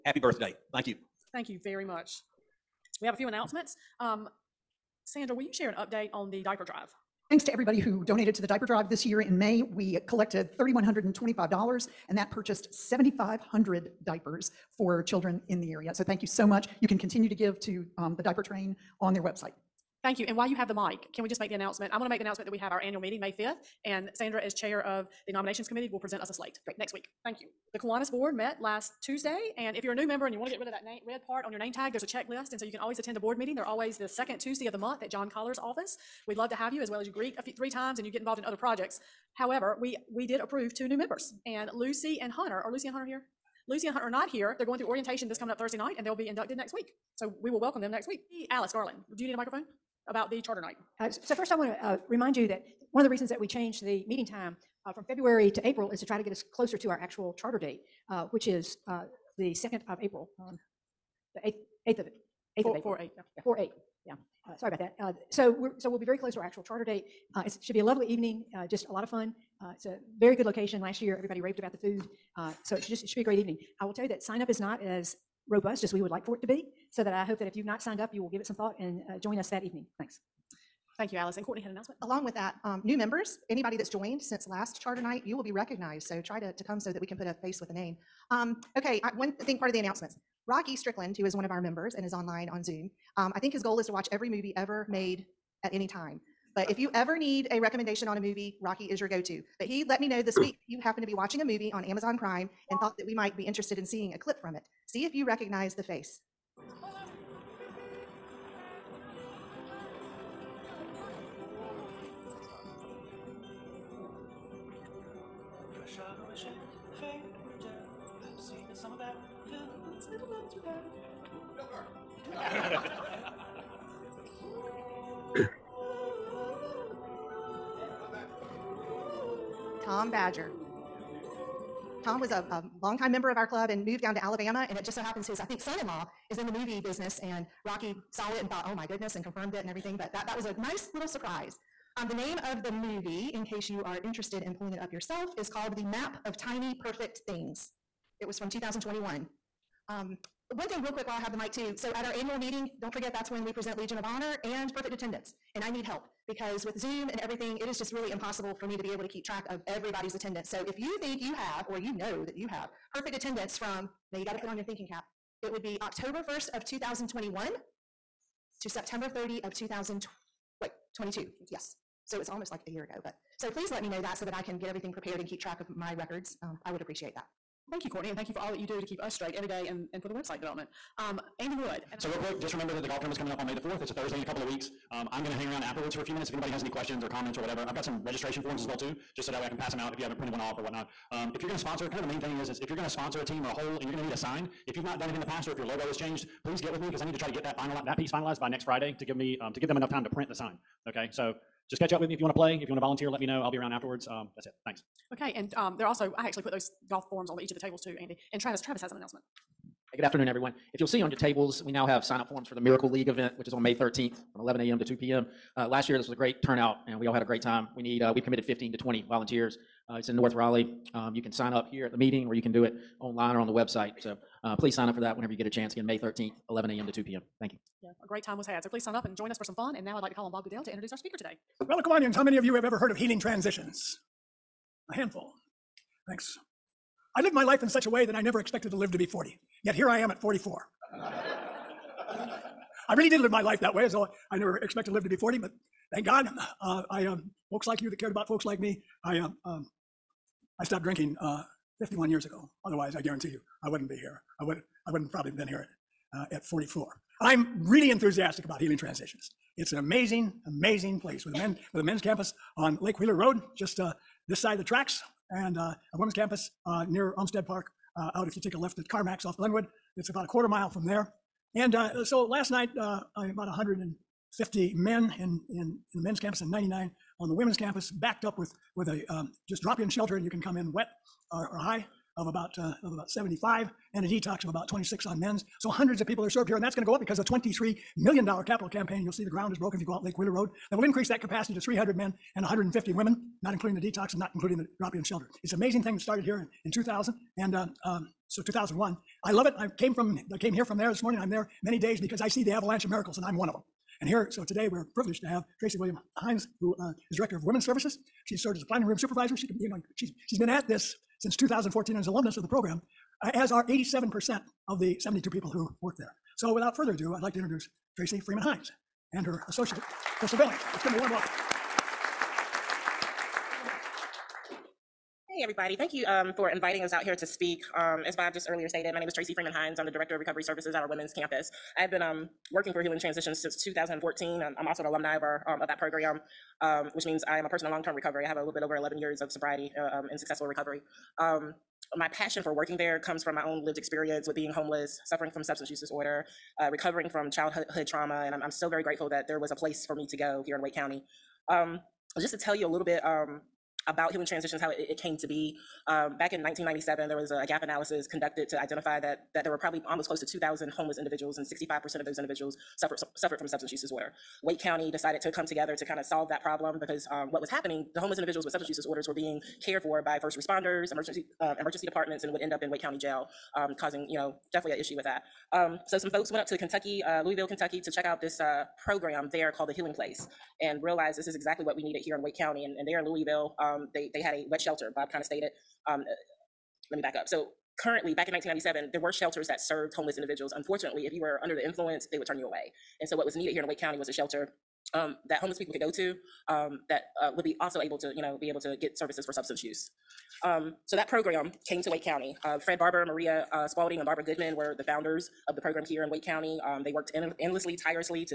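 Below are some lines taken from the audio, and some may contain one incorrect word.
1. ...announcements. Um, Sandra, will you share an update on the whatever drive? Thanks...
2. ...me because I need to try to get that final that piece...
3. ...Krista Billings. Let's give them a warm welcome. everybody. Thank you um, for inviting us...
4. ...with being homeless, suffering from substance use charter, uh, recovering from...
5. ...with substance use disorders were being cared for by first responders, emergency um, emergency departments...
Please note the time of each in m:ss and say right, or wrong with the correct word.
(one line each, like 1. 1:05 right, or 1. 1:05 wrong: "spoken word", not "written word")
1. 0:03 wrong: "diaper", not "whatever"
2. 3:16 right
3. 5:20 right
4. 5:44 wrong: "disorder", not "charter"
5. 6:08 right.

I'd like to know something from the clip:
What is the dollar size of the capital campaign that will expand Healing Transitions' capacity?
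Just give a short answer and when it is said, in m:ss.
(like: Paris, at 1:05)
$23 million, at 4:47.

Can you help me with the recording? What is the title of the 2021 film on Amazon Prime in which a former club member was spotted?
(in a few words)
The Map of Tiny Perfect Things.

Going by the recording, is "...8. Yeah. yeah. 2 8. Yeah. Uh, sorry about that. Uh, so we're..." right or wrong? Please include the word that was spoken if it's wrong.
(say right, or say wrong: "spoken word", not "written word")
wrong: "4", not "2".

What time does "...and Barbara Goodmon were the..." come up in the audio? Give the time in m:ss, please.
6:43.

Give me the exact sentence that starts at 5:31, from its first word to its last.
I've been um, working for Healing Transitions since 2014.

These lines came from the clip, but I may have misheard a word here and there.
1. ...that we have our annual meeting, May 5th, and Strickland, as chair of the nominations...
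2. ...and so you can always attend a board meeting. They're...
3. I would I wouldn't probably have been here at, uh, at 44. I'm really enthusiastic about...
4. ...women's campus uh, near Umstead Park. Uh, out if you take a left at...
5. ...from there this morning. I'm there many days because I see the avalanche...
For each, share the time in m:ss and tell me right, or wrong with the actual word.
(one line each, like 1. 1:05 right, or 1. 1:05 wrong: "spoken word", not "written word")
1. 0:22 wrong: "Sandra", not "Strickland"
2. 0:32 right
3. 4:14 right
4. 4:25 right
5. 5:00 right.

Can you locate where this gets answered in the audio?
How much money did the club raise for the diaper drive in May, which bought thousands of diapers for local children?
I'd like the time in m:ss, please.
0:10.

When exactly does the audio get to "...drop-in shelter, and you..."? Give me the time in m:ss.
4:39.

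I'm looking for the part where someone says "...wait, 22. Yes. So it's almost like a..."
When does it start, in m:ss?
2:50.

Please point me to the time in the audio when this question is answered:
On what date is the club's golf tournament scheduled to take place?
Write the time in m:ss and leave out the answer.
3:03.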